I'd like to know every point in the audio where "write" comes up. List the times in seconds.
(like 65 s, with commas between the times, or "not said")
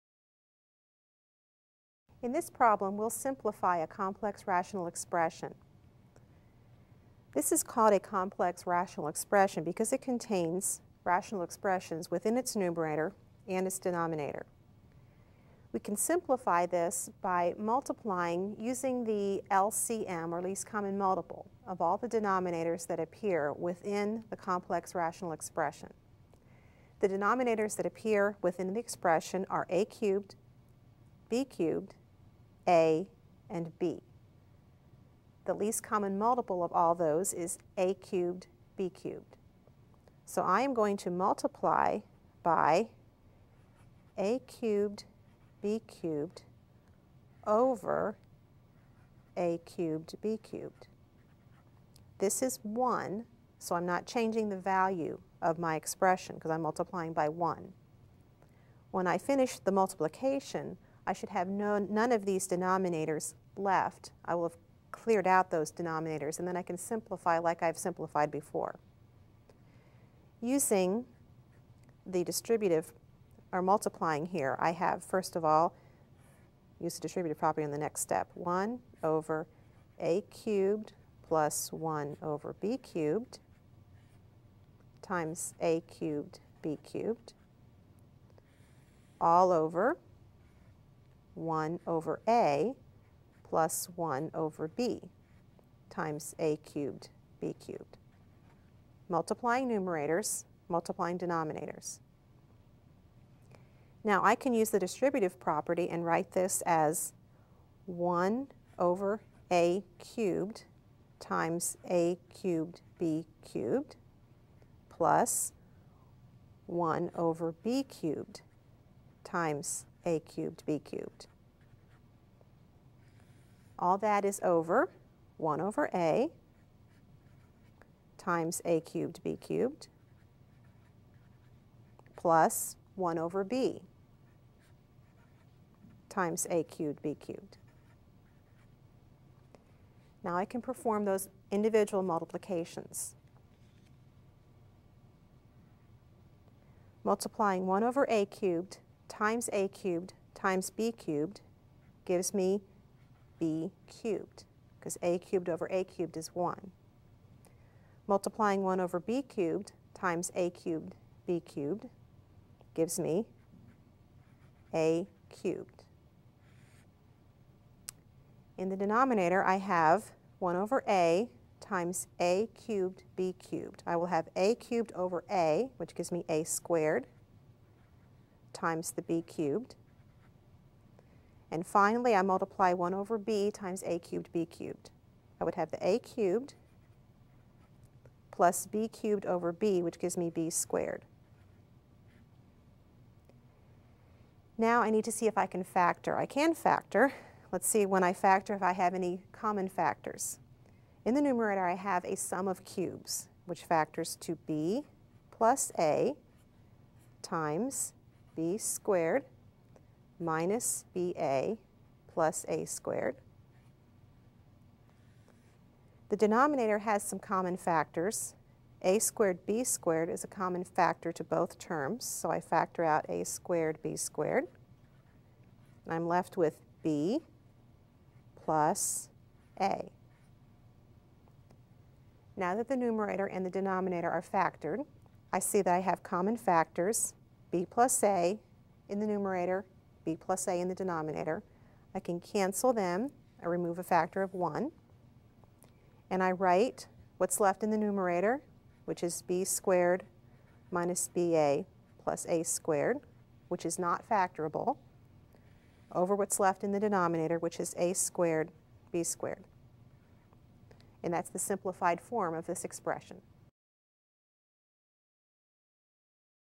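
106 s, 246 s.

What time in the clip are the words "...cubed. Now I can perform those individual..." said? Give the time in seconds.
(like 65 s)
137 s.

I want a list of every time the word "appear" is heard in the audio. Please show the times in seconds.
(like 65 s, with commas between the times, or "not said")
22 s, 27 s.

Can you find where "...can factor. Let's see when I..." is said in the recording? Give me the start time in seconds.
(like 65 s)
196 s.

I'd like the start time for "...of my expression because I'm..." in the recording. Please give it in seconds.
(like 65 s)
55 s.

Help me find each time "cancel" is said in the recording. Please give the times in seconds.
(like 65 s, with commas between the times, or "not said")
242 s.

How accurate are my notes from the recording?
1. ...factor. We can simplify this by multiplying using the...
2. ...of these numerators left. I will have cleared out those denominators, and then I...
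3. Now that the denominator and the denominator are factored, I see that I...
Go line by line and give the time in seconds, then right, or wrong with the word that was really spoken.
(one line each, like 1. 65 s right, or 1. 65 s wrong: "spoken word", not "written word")
1. 13 s wrong: "denominator", not "factor"
2. 62 s wrong: "denominators", not "numerators"
3. 232 s wrong: "numerator", not "denominator".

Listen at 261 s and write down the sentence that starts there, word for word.
And that's the simplified form of this expression.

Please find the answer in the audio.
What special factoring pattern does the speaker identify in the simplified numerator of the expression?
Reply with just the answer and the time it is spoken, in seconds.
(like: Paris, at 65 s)
sum of cubes, at 202 s.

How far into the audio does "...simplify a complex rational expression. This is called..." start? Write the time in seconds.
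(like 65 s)
3 s.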